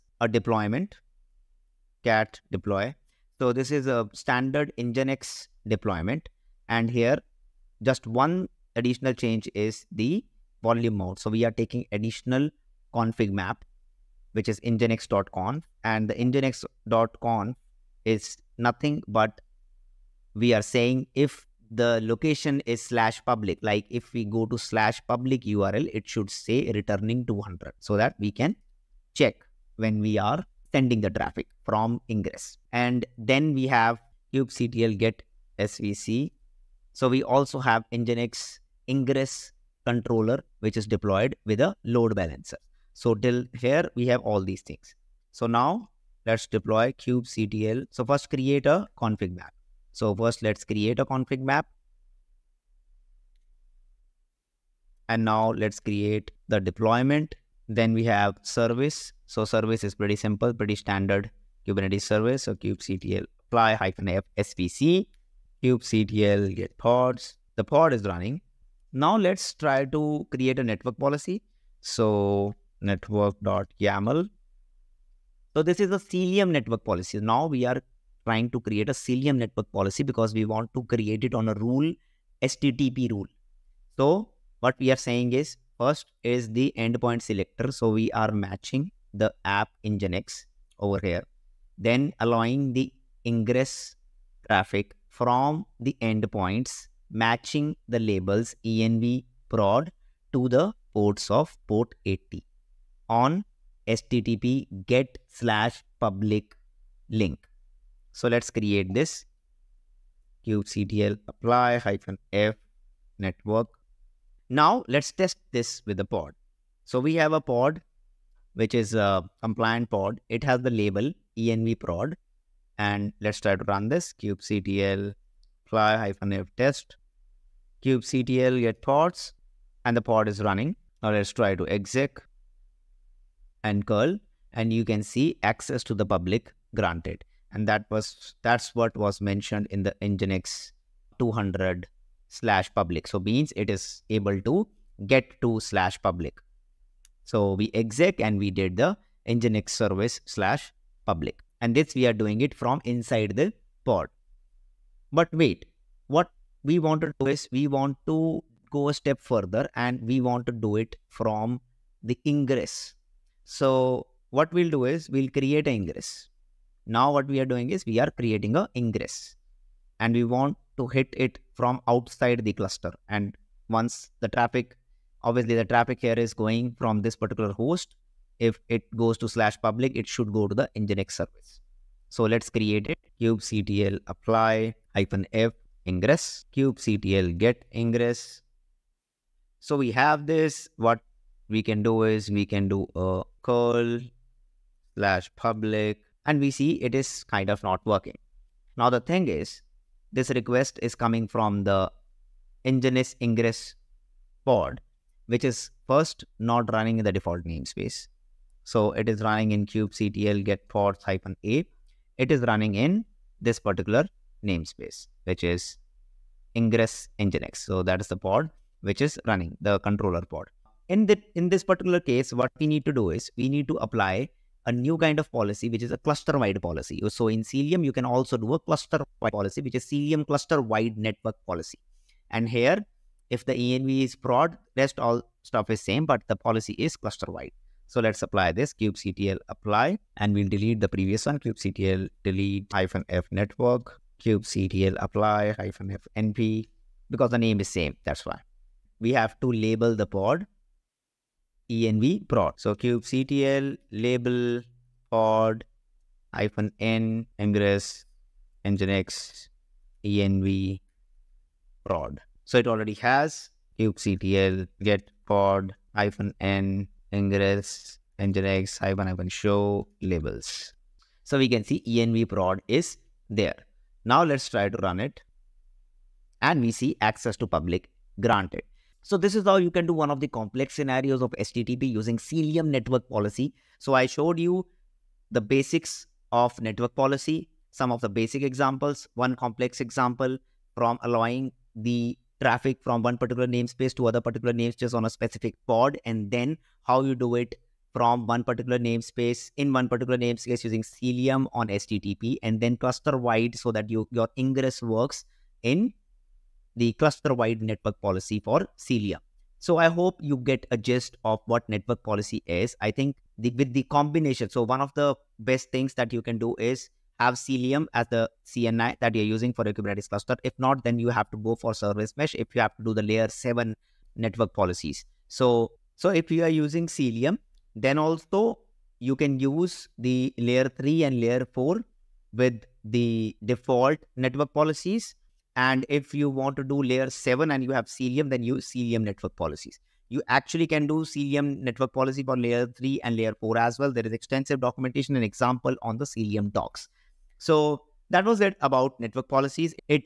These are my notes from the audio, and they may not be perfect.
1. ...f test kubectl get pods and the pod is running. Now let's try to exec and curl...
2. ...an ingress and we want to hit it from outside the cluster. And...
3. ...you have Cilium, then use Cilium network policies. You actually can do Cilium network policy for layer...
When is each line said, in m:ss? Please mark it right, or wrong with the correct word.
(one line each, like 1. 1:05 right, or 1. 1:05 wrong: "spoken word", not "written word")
1. 2:06 right
2. 2:48 right
3. 5:37 right.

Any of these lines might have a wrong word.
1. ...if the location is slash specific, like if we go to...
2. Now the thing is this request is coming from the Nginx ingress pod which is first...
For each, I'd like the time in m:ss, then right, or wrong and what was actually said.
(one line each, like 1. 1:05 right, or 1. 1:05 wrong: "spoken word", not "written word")
1. 0:21 wrong: "public", not "specific"
2. 3:18 right.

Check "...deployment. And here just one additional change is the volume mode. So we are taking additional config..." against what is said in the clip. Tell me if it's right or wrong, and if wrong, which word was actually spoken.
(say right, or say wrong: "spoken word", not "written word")
right.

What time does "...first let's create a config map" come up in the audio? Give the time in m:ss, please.
0:50.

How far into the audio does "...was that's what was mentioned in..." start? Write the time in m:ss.
2:17.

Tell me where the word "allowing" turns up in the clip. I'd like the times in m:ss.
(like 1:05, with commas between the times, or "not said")
1:32, 4:51.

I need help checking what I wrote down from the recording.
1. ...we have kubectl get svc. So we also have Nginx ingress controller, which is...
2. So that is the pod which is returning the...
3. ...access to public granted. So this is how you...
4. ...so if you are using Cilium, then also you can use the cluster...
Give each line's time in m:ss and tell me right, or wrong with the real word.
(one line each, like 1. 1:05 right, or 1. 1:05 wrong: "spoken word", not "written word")
1. 0:33 right
2. 3:37 wrong: "running", not "returning"
3. 4:37 right
4. 5:25 wrong: "layer", not "cluster".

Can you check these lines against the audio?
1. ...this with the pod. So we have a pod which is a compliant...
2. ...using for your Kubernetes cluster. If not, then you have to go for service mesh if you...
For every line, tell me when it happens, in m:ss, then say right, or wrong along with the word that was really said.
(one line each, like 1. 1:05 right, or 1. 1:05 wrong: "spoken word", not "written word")
1. 1:55 right
2. 5:19 right.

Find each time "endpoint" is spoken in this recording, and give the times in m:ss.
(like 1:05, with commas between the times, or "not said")
1:26, 1:36.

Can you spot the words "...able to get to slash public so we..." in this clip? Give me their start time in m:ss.
2:24.